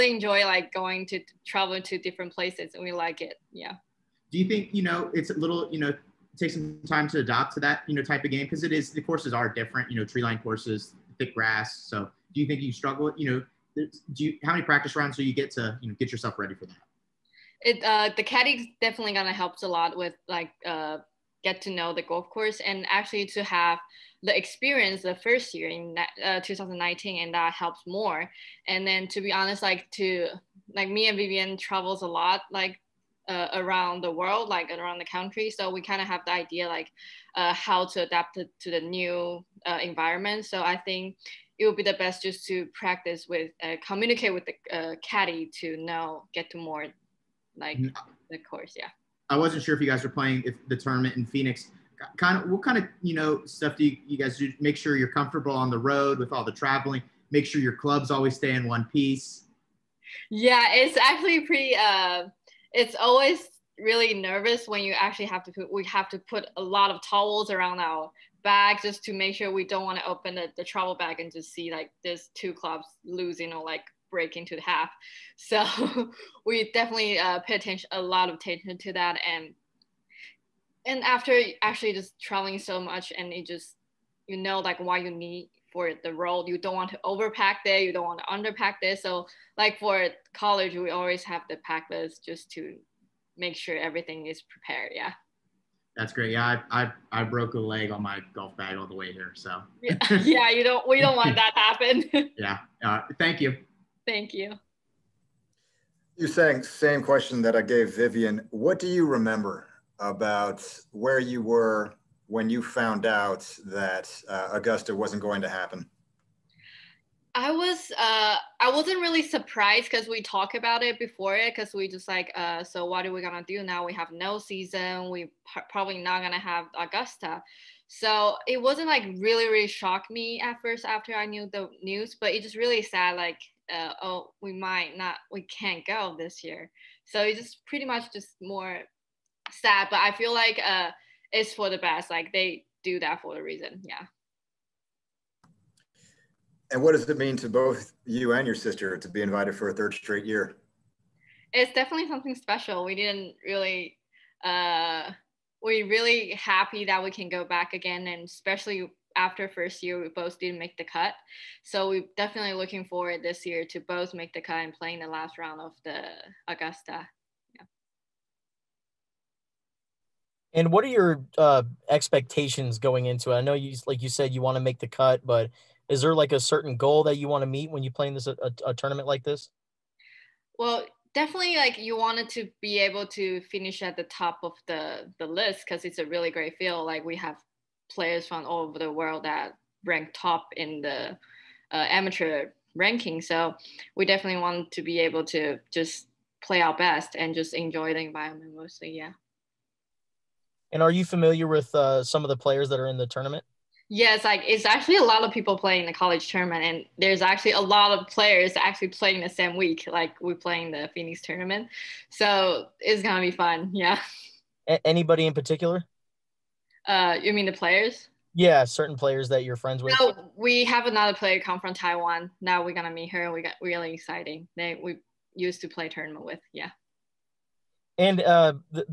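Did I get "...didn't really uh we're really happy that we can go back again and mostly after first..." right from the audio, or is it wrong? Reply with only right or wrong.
wrong.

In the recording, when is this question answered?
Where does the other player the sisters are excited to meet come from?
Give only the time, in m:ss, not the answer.
3:41.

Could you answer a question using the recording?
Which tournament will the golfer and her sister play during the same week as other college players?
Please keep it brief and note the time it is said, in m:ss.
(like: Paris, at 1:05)
Phoenix tournament, at 3:30.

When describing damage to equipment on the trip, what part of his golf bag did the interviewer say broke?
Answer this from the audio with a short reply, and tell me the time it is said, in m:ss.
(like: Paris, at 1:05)
A leg, at 1:37.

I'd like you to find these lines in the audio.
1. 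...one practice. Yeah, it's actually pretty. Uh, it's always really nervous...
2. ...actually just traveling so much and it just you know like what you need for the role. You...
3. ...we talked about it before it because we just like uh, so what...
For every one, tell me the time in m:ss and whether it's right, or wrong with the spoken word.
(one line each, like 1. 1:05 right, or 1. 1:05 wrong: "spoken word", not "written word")
1. 0:58 wrong: "piece", not "practice"
2. 1:21 right
3. 2:00 right.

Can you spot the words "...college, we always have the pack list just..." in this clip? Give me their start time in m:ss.
1:30.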